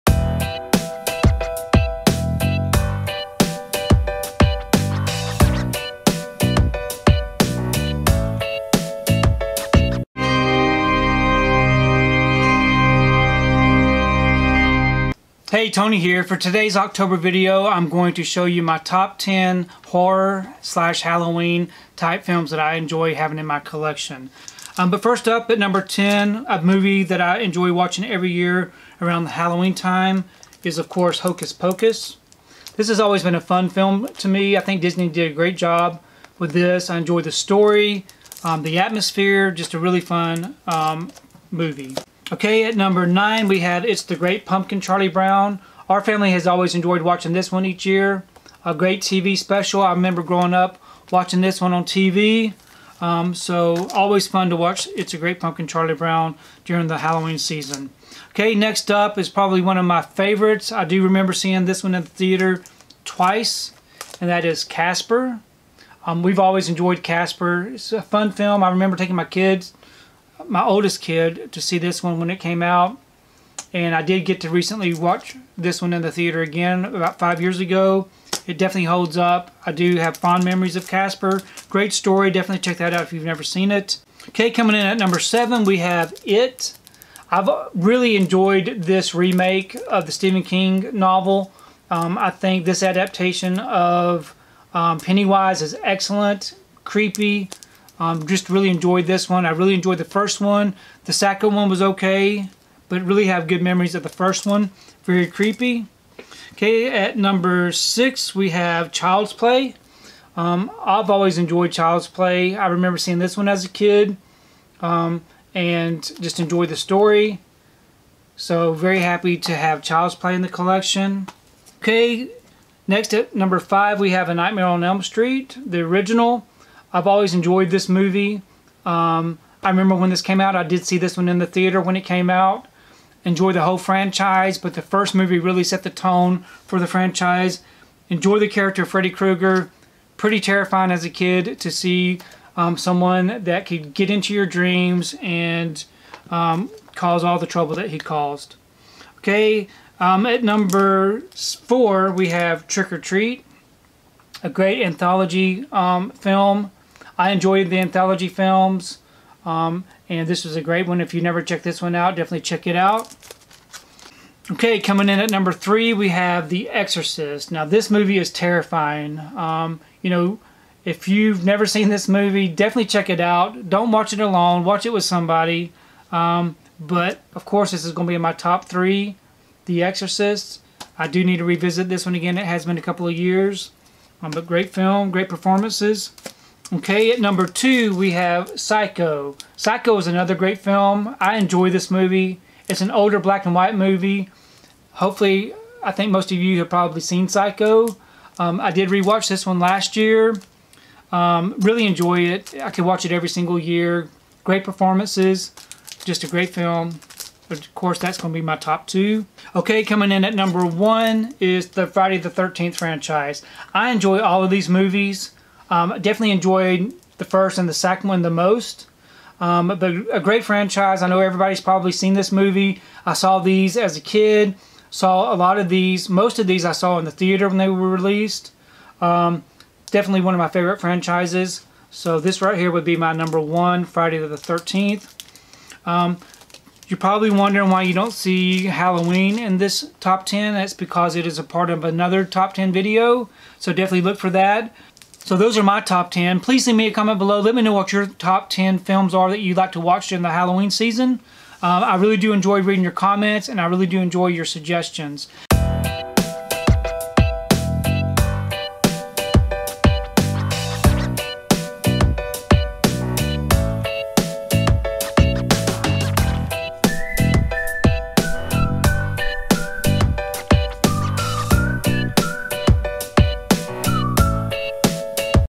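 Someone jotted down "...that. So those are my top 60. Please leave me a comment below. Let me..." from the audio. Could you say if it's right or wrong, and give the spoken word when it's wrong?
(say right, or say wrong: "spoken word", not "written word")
wrong: "10", not "60".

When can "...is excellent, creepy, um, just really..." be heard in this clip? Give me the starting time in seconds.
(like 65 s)
95 s.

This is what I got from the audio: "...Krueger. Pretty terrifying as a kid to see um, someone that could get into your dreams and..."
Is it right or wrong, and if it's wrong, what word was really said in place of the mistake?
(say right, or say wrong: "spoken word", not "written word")
right.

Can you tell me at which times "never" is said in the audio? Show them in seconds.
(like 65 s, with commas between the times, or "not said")
83 s, 161 s, 171 s.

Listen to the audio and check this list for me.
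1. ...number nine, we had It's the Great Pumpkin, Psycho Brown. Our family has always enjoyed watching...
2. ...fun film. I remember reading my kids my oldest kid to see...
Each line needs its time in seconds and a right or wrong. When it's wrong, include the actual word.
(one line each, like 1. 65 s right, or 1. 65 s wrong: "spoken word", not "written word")
1. 42 s wrong: "Charlie", not "Psycho"
2. 68 s wrong: "taking", not "reading".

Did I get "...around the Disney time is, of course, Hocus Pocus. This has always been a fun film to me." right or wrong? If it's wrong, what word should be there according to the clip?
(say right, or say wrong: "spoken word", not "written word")
wrong: "Halloween", not "Disney".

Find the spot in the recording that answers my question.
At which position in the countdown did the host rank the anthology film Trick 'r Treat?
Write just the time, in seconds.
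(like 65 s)
150 s.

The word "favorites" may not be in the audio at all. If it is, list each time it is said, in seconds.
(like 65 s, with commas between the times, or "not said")
60 s, 230 s.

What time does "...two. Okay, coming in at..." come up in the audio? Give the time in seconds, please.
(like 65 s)
208 s.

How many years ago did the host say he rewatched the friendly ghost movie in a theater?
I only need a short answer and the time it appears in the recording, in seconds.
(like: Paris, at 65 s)
5, at 77 s.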